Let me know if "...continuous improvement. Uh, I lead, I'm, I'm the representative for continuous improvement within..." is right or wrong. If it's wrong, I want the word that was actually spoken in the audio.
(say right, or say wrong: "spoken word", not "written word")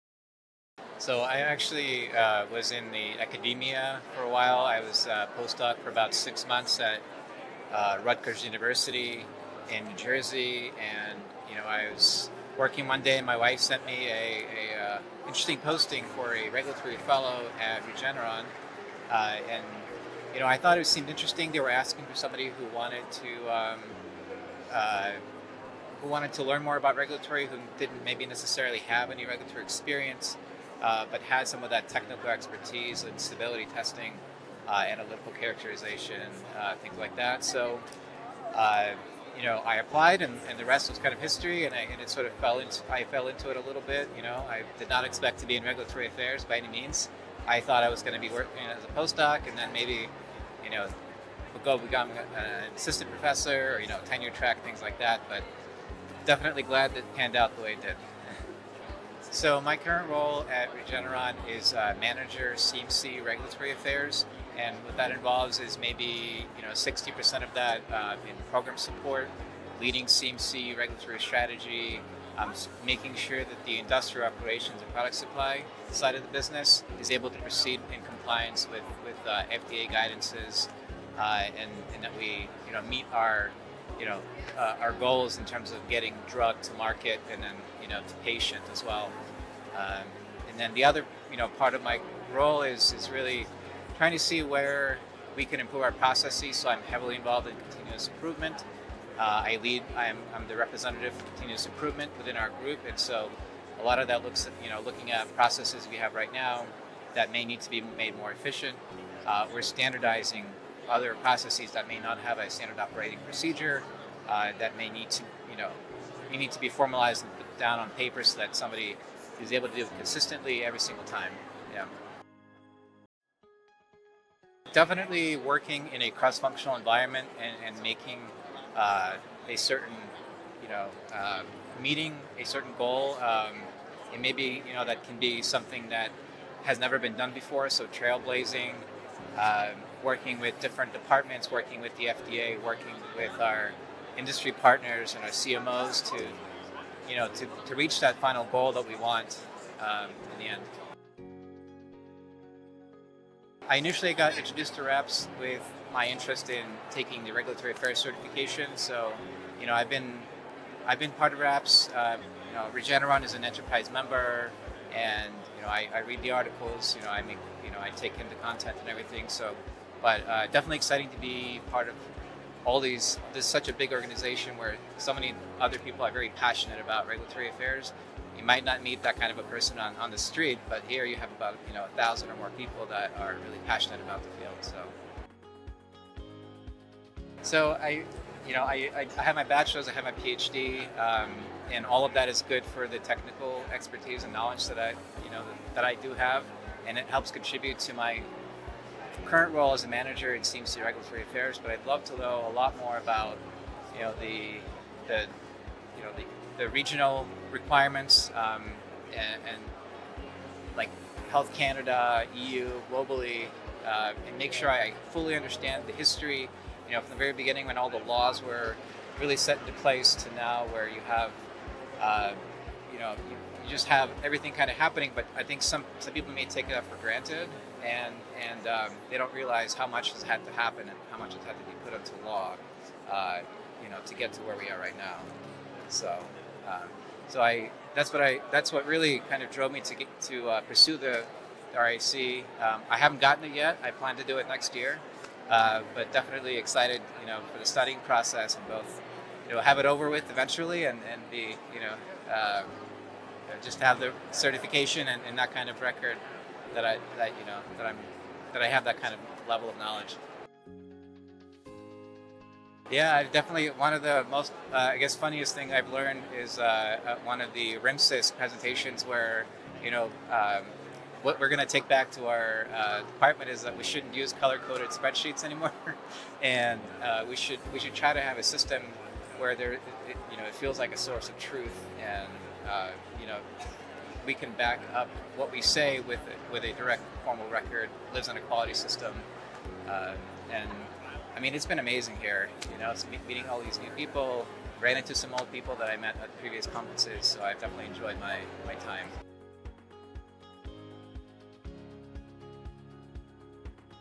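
right.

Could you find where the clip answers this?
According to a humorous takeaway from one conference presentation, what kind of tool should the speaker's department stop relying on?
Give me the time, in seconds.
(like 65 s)
274 s.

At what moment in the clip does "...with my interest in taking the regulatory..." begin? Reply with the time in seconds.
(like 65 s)
155 s.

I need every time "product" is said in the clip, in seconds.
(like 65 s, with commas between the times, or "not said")
74 s.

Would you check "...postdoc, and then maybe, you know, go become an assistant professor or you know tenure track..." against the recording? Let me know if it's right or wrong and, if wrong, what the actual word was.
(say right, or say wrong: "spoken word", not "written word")
right.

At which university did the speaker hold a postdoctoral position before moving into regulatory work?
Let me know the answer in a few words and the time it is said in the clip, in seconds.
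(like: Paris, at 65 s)
Rutgers University, at 8 s.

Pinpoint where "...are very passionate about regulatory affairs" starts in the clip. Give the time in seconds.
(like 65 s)
176 s.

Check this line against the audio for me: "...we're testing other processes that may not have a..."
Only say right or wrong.
wrong.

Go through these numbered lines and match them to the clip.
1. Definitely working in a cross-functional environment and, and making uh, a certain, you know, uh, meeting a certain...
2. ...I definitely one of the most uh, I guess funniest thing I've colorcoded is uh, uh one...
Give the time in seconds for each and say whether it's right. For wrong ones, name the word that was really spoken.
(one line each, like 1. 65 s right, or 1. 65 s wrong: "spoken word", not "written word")
1. 124 s right
2. 263 s wrong: "learned", not "colorcoded".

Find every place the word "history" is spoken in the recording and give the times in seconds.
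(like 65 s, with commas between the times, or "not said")
41 s, 215 s.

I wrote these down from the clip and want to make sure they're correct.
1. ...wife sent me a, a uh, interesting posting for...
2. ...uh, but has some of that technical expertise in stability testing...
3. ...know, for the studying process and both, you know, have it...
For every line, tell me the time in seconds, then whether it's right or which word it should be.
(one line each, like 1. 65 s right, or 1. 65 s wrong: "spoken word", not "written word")
1. 13 s right
2. 30 s right
3. 247 s right.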